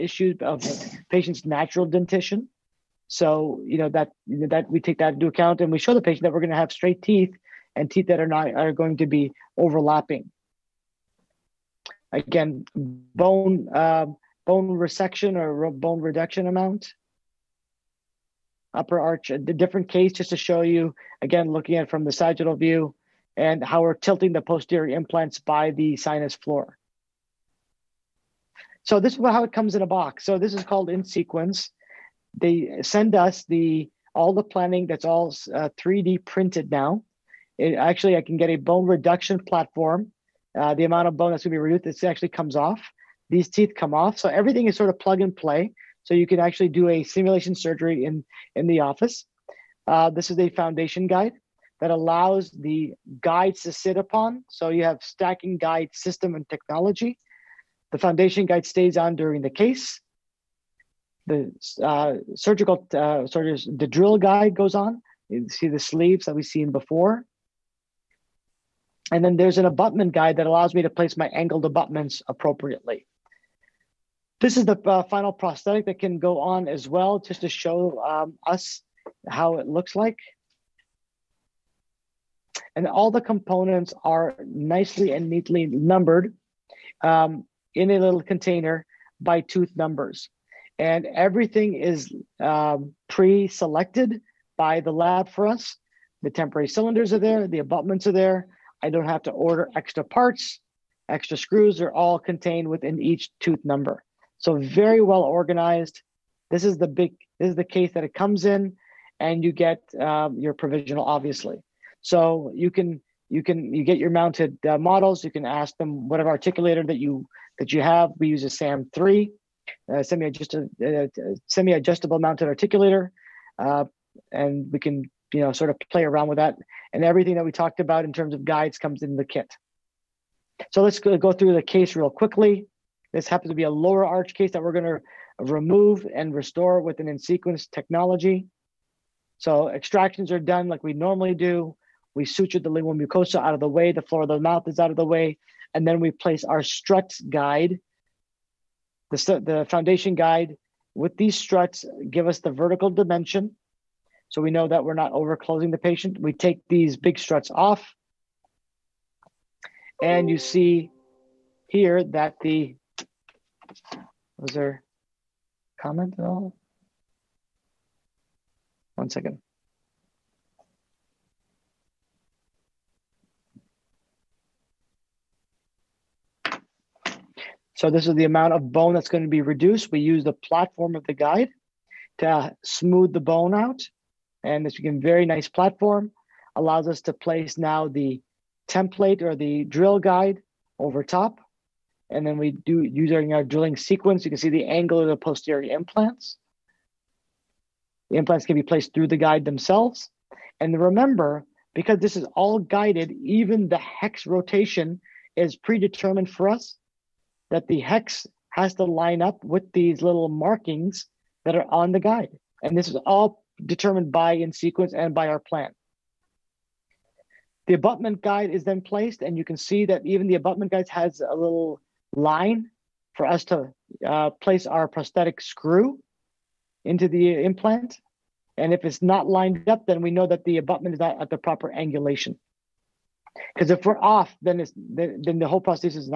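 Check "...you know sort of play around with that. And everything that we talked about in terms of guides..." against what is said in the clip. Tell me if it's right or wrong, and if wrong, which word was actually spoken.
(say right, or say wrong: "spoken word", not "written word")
right.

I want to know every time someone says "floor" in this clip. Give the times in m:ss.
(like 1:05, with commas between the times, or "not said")
0:26, 2:24.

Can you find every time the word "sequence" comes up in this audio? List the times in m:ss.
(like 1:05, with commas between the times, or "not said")
0:31, 2:17, 3:13, 3:34.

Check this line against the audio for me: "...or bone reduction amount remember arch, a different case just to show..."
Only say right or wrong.
wrong.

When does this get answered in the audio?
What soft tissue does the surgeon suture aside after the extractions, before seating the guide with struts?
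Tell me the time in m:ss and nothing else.
2:22.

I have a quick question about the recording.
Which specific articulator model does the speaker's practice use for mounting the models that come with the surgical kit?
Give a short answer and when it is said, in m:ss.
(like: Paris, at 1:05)
SAM 3, at 1:58.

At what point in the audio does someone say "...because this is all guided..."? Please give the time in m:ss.
3:21.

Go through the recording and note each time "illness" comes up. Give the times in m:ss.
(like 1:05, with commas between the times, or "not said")
not said.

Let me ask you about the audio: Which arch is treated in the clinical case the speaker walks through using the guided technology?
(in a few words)
Lower arch.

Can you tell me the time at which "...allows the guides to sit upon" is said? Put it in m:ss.
0:51.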